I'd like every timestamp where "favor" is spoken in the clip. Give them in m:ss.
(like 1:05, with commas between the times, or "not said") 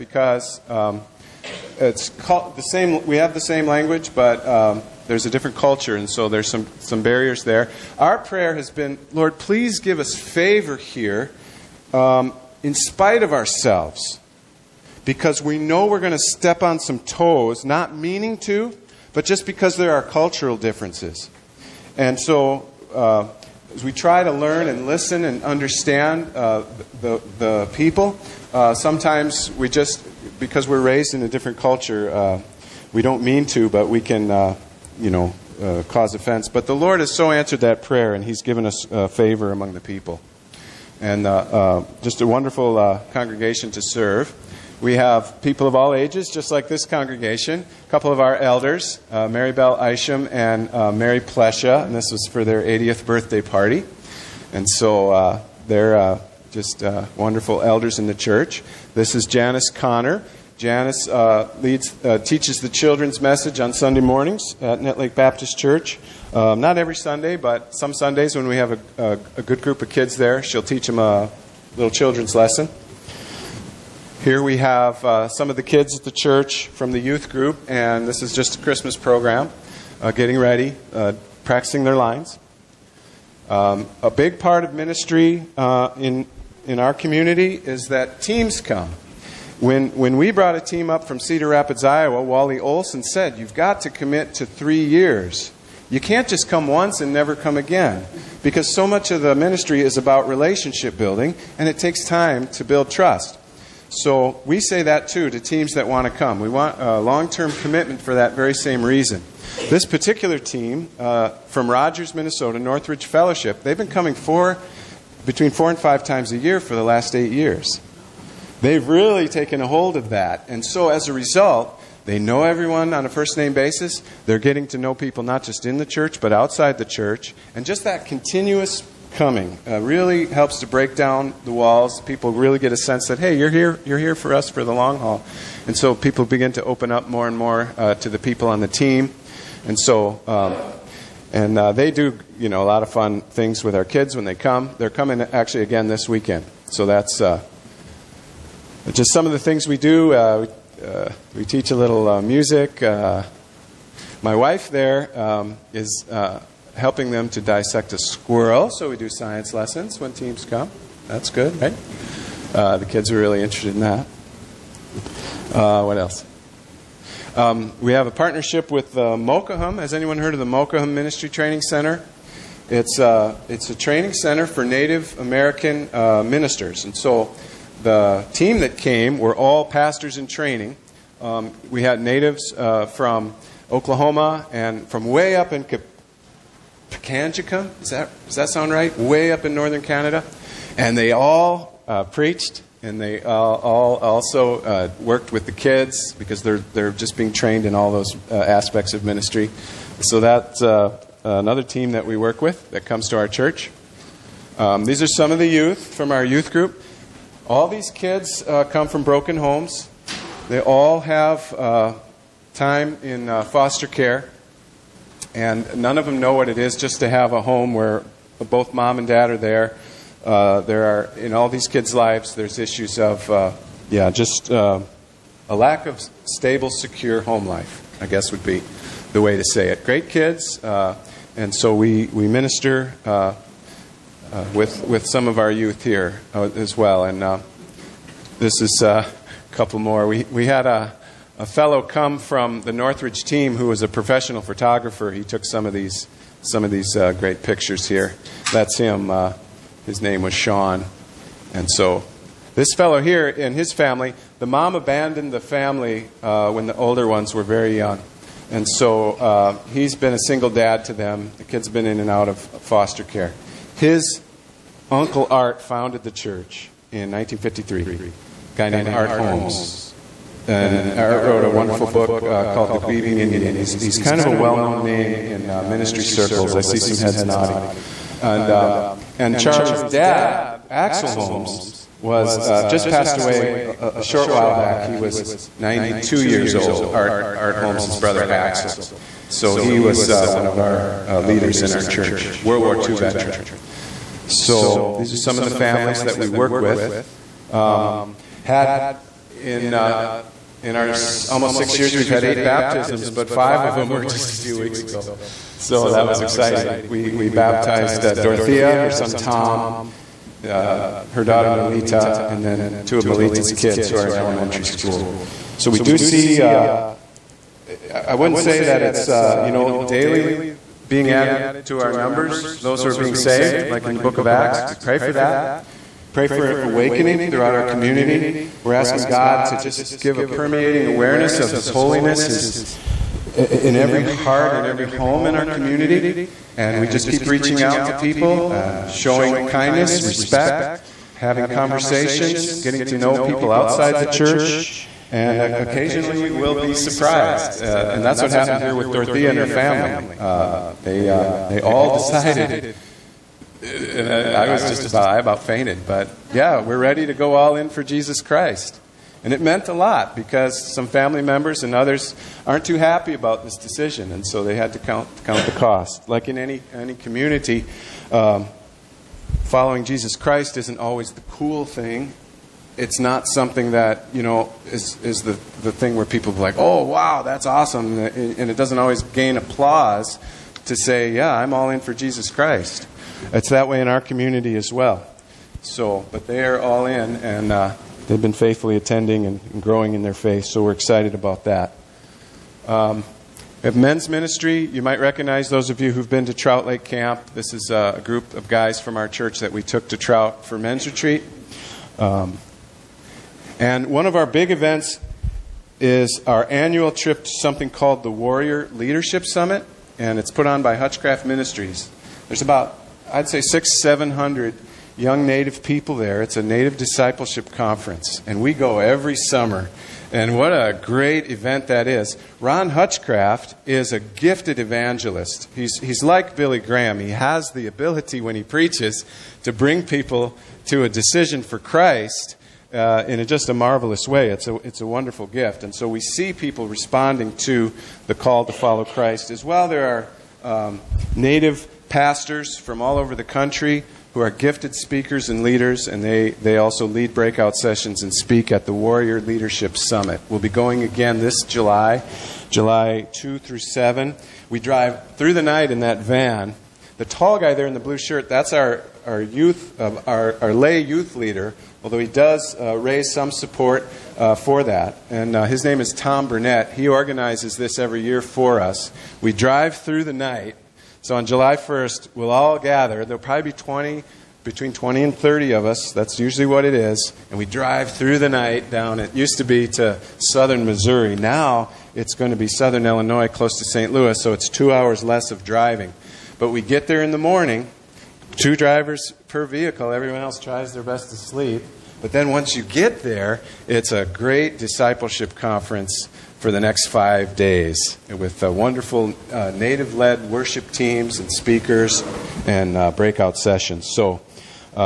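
0:10, 0:39.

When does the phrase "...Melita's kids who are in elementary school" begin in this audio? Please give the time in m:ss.
5:13.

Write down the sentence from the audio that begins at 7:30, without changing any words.
We'll be going again this July, July 2 through 7.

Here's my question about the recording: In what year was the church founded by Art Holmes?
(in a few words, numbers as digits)
1953.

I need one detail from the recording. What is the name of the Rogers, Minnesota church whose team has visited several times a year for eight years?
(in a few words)
Northridge Fellowship.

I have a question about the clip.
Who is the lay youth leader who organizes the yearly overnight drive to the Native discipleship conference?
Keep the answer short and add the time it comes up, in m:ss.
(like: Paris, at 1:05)
Tom Burnett, at 7:45.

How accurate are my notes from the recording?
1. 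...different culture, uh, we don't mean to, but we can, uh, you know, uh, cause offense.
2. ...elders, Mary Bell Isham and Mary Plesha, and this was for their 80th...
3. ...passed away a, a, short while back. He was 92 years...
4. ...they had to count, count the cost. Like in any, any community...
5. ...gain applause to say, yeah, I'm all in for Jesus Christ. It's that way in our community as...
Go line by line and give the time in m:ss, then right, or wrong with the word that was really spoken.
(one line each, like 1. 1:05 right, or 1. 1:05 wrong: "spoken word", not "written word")
1. 0:31 right
2. 0:48 right
3. 4:42 right
4. 6:04 right
5. 6:19 right.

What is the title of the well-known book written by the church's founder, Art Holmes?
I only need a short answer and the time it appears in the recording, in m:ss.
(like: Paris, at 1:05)
The Grieving Indian, at 4:32.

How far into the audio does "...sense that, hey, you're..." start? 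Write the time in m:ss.
2:12.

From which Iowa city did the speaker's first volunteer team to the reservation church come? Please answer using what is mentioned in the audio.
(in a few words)
Cedar Rapids.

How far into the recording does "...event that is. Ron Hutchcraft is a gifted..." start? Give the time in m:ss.
7:01.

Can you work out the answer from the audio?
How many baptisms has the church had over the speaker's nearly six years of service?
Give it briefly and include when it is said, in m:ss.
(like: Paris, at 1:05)
8, at 5:02.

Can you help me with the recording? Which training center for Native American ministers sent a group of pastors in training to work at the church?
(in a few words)
Mokahum Ministry Training Center.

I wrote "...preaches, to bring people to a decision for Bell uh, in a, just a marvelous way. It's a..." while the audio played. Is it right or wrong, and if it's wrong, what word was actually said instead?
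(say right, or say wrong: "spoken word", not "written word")
wrong: "Christ", not "Bell".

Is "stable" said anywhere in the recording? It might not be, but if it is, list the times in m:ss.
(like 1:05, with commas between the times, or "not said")
3:46.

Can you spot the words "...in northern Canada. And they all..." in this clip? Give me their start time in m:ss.
3:09.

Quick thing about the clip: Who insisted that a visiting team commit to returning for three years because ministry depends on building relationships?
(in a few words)
Wally Olson.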